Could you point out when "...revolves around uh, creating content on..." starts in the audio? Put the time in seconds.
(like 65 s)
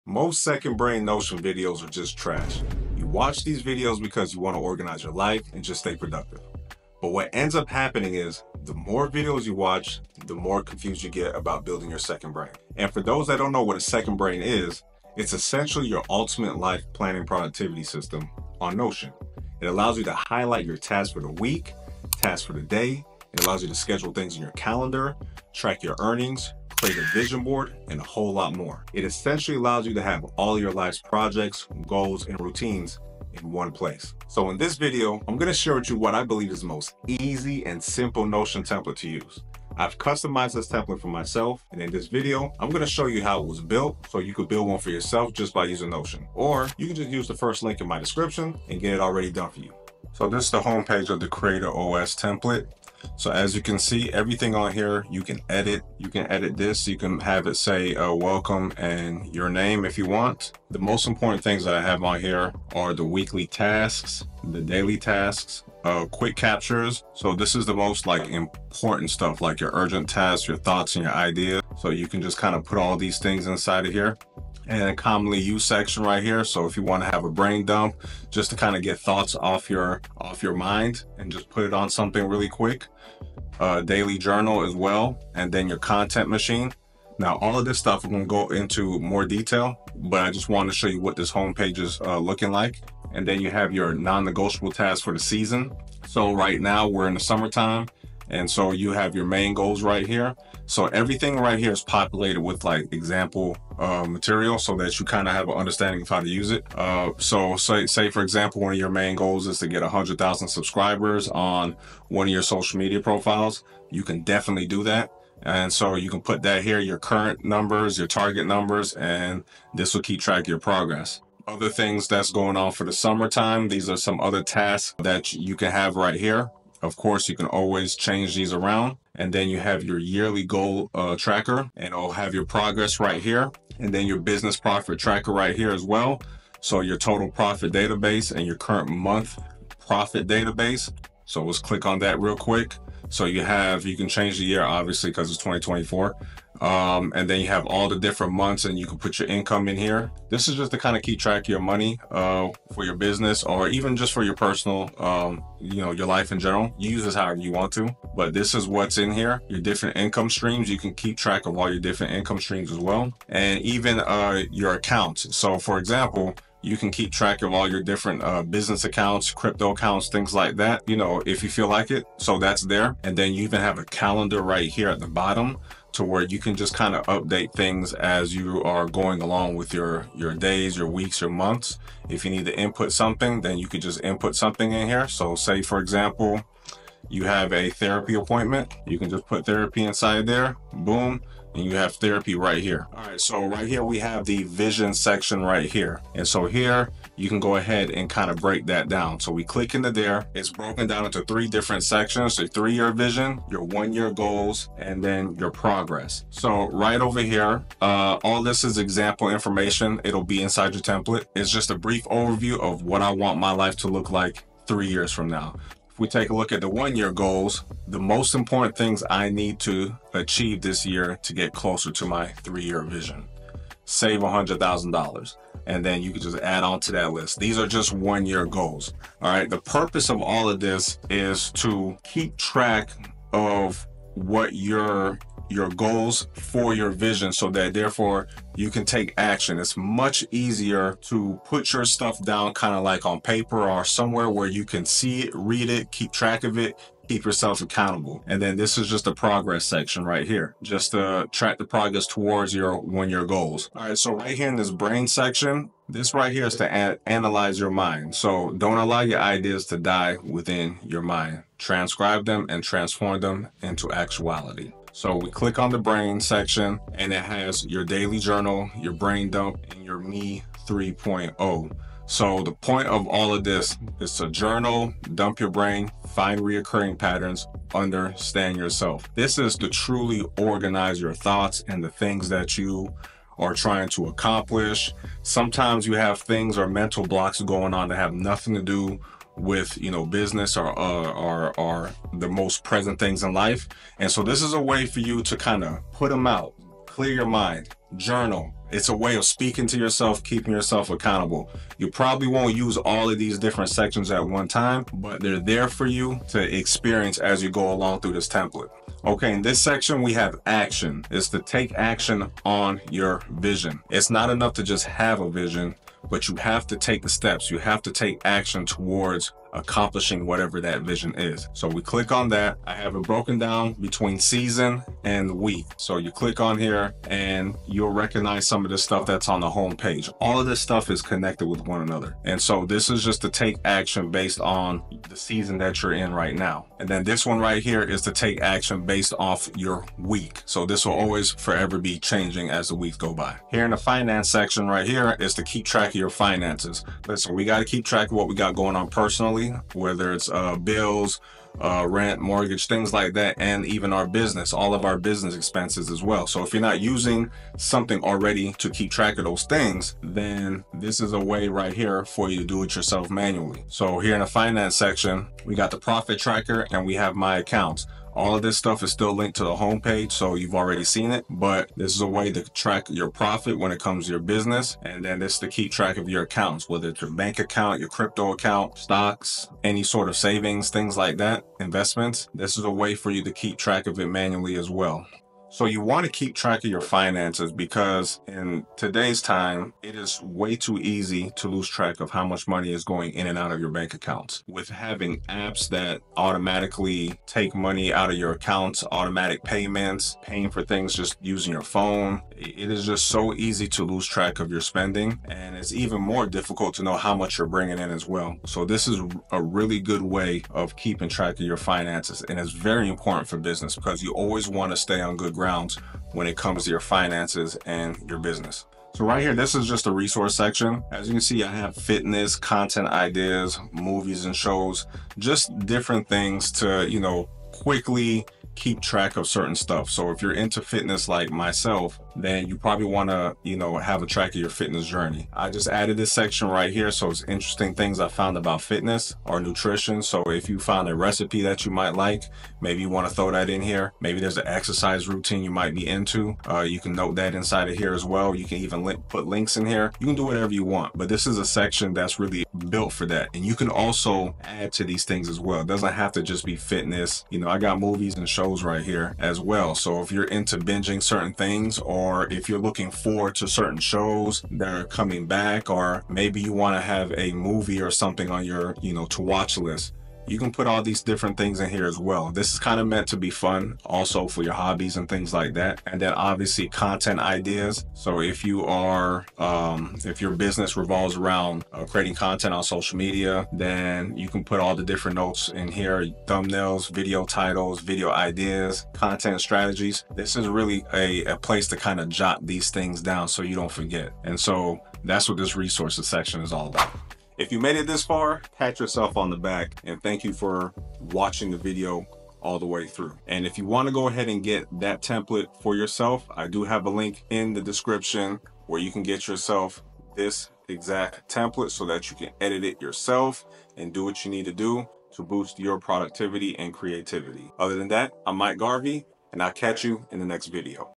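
480 s.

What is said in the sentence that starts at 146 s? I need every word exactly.
Um, and then you have all the different months and you can put your income in here.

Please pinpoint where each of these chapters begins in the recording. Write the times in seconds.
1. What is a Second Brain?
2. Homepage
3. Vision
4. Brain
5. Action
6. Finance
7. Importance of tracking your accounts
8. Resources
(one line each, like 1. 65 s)
1. 15 s
2. 51 s
3. 193 s
4. 254 s
5. 309 s
6. 344 s
7. 386 s
8. 420 s.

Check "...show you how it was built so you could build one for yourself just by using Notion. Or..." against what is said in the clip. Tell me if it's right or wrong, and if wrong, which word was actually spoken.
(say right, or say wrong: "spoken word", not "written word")
right.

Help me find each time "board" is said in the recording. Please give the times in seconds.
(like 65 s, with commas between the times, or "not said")
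27 s.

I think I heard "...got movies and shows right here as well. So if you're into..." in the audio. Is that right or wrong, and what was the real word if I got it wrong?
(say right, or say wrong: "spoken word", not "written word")
right.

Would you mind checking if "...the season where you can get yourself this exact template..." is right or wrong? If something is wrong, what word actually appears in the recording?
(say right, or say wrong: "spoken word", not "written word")
wrong: "description", not "season".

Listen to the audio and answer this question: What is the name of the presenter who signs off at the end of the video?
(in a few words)
Mike Garvey.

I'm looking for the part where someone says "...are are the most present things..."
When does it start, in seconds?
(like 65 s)
290 s.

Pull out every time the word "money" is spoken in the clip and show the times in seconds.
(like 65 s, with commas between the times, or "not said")
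151 s, 392 s, 397 s.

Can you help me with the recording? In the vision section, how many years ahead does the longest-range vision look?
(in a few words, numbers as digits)
3 years.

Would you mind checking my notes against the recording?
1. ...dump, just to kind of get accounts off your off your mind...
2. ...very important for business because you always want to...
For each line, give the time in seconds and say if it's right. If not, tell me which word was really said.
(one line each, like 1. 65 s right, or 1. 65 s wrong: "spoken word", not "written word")
1. 77 s wrong: "thoughts", not "accounts"
2. 412 s right.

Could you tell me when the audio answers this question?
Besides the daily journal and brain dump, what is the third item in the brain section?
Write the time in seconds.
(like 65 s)
269 s.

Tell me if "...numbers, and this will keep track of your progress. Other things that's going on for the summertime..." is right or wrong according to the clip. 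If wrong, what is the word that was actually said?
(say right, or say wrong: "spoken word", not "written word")
right.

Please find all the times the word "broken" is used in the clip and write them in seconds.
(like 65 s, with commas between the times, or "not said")
200 s, 323 s.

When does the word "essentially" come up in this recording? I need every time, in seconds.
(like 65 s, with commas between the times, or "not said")
15 s, 29 s.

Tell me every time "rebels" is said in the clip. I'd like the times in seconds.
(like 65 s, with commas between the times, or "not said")
not said.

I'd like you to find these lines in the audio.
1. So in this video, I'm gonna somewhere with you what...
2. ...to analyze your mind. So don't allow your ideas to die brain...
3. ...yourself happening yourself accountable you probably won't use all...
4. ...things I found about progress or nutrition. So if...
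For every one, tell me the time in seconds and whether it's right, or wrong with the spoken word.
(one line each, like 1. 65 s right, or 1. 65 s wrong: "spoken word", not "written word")
1. 34 s wrong: "share", not "somewhere"
2. 256 s wrong: "within", not "brain"
3. 299 s wrong: "keeping", not "happening"
4. 437 s wrong: "fitness", not "progress".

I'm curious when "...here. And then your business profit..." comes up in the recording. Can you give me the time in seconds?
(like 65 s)
133 s.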